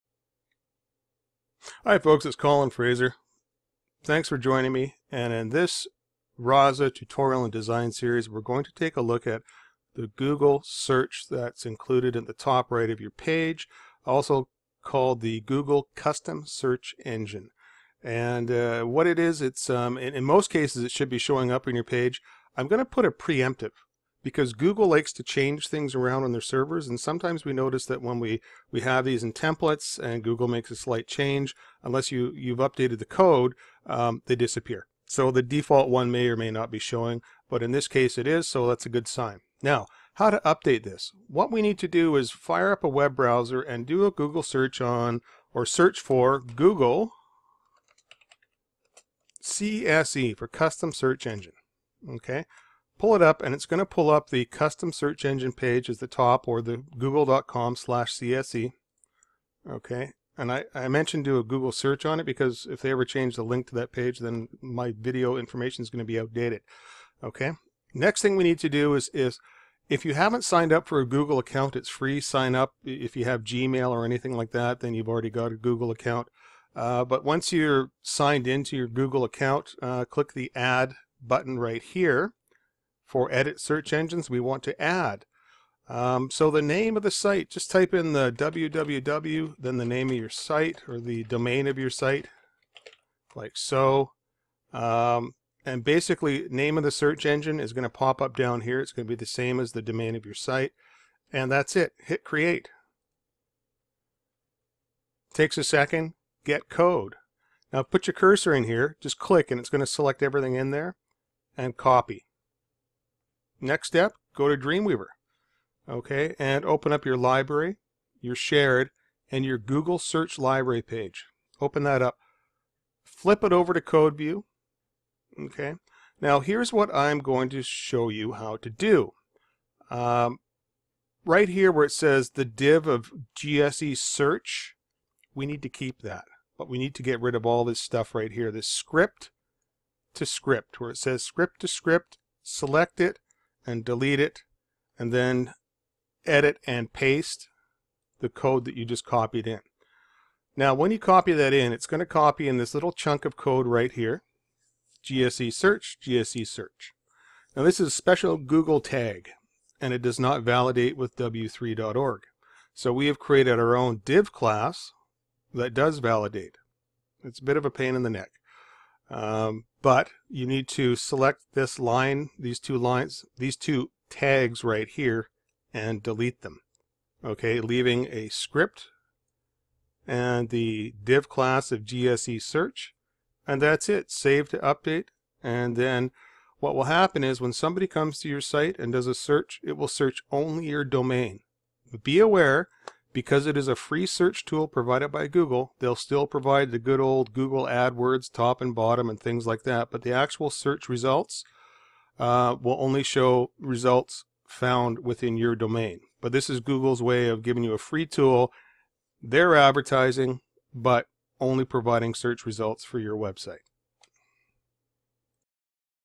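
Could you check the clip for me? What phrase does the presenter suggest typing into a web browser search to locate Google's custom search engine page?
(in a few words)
Google CSE.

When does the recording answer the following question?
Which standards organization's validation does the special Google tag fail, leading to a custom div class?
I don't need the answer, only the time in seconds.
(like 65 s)
161 s.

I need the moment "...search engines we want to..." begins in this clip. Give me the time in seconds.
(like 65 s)
83 s.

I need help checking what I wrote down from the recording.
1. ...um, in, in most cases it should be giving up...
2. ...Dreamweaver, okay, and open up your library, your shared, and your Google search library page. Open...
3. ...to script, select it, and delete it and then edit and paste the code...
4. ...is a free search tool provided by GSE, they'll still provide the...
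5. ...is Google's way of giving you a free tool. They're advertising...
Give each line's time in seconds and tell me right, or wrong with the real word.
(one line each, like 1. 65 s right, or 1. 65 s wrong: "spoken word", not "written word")
1. 19 s wrong: "showing", not "giving"
2. 114 s right
3. 141 s right
4. 193 s wrong: "Google", not "GSE"
5. 206 s right.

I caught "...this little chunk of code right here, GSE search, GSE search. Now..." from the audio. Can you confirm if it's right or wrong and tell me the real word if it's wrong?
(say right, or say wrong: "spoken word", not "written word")
right.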